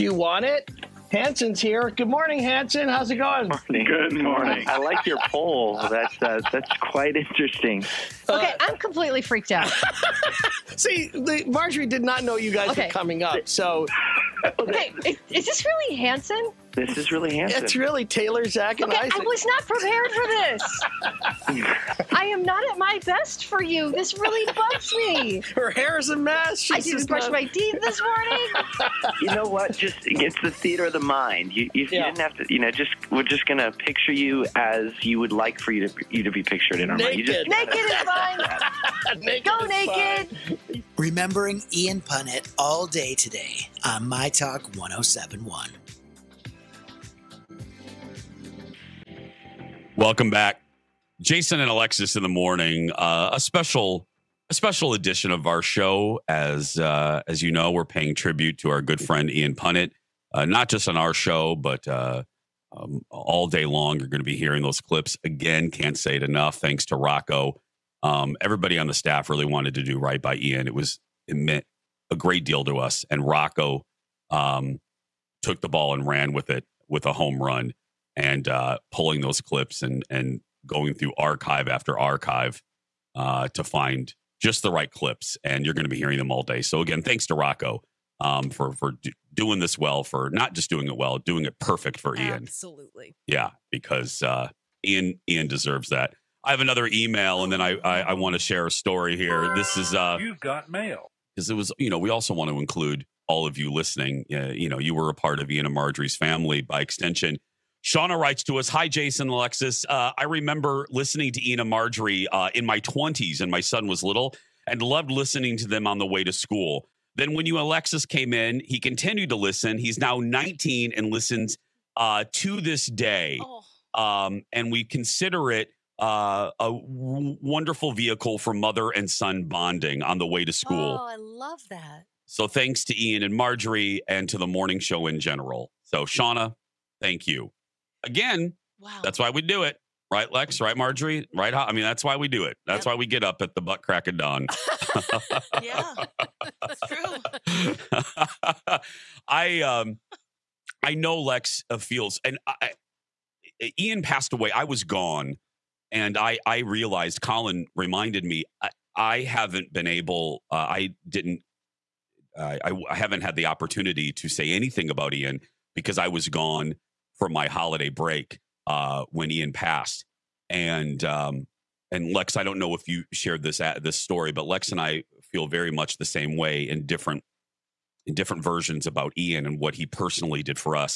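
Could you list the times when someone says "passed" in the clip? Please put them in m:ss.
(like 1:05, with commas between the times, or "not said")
2:34, 2:49.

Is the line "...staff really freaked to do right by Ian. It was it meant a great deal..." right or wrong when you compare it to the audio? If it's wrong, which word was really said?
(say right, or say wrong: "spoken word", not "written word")
wrong: "wanted", not "freaked".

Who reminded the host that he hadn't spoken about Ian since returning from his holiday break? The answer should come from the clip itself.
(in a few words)
Colin.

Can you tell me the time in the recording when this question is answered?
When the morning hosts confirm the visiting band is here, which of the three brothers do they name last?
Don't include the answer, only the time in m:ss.
0:19.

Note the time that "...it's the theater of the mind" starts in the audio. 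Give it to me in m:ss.
0:30.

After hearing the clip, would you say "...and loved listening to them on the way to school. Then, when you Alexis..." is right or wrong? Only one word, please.
right.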